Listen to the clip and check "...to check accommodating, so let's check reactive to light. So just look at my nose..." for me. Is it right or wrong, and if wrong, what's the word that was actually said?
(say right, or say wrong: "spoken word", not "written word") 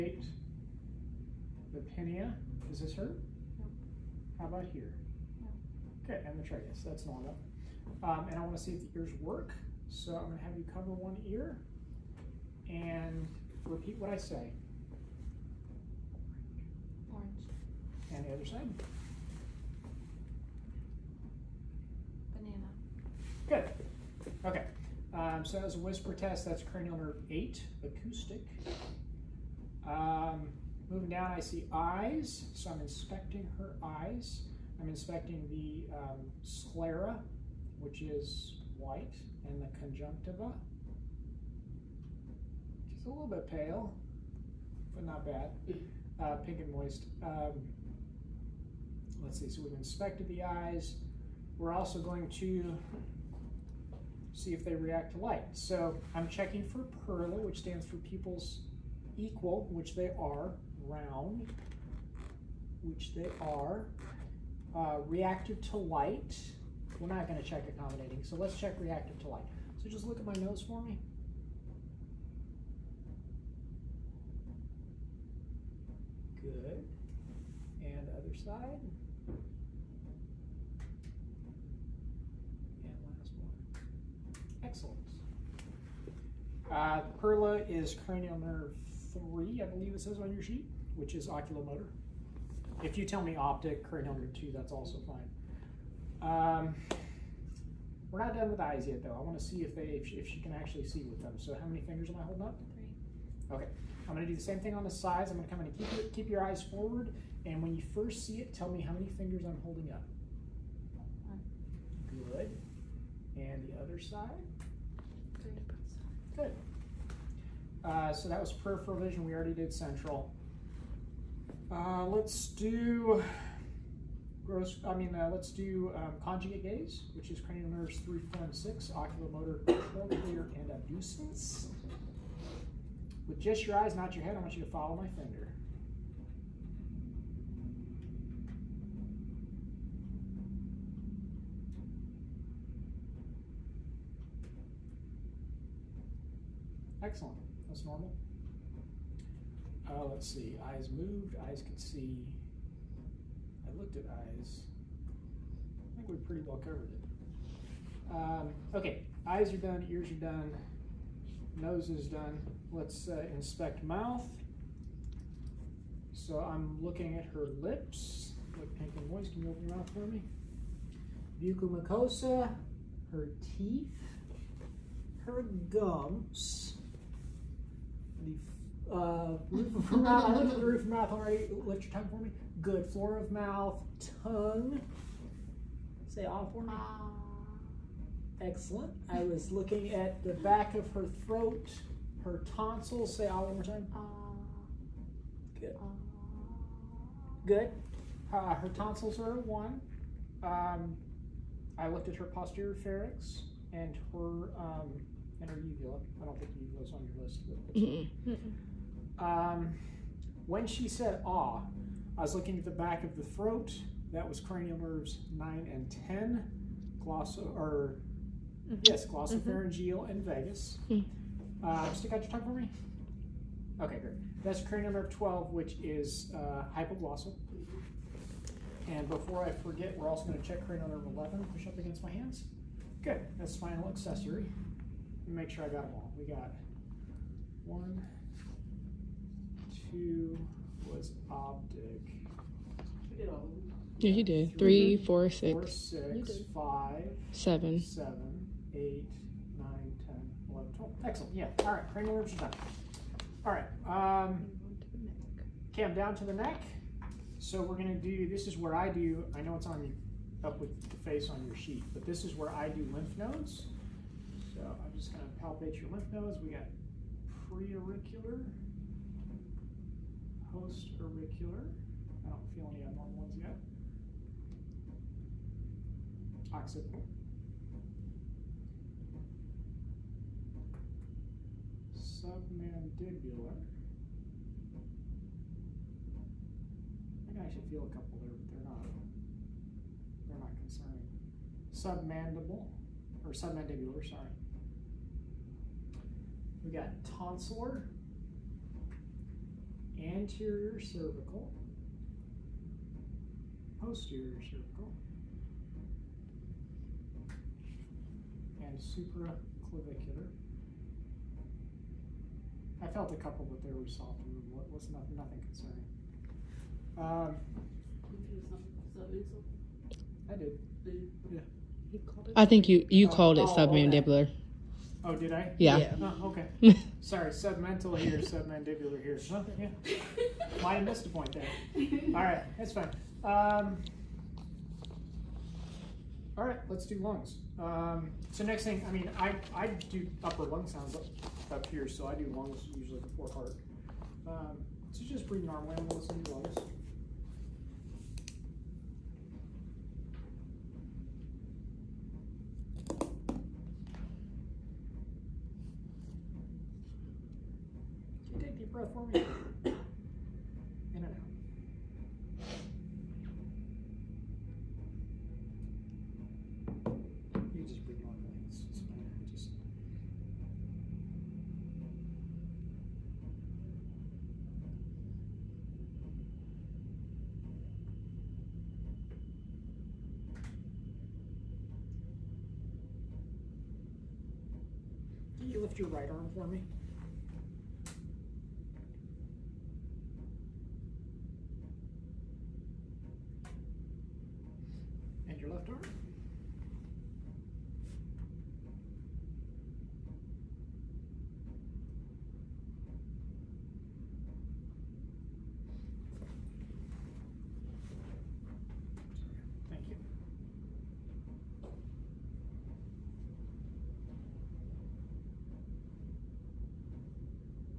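right.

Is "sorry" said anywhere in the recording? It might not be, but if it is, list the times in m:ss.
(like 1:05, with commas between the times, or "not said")
4:54, 5:27.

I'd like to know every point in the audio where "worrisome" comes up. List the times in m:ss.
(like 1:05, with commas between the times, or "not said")
not said.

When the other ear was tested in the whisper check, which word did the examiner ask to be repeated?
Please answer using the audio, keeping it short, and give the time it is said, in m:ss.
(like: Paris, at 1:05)
Banana, at 0:22.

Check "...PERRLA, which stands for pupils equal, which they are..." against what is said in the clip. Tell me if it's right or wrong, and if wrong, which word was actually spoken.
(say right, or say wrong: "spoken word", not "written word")
right.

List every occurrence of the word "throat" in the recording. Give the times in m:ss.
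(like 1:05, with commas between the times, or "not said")
3:11, 3:33.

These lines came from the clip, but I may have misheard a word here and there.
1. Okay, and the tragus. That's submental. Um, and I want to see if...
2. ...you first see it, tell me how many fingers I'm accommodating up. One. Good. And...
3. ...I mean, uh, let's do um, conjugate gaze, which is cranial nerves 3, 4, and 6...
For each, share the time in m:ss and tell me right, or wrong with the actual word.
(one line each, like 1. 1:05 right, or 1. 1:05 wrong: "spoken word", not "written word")
1. 0:06 wrong: "normal", not "submental"
2. 1:47 wrong: "holding", not "accommodating"
3. 2:04 right.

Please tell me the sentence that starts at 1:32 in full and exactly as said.
If you tell me optic, cranial nerve 2, that's also fine.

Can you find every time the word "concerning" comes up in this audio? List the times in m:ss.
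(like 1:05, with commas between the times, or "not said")
4:50, 5:15.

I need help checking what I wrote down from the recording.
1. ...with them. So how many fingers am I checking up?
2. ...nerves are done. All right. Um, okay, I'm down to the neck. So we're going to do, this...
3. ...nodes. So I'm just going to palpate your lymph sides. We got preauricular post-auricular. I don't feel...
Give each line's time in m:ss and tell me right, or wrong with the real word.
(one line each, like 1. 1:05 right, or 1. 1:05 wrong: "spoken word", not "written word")
1. 1:41 wrong: "holding", not "checking"
2. 4:12 right
3. 4:23 wrong: "nodes", not "sides".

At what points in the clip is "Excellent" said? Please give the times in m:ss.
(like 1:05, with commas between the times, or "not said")
1:24, 2:27, 3:08, 4:11.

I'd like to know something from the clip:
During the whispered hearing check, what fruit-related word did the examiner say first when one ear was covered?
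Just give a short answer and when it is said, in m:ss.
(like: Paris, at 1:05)
Orange, at 0:17.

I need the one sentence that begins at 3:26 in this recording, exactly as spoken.
I don't think uvula is on your list.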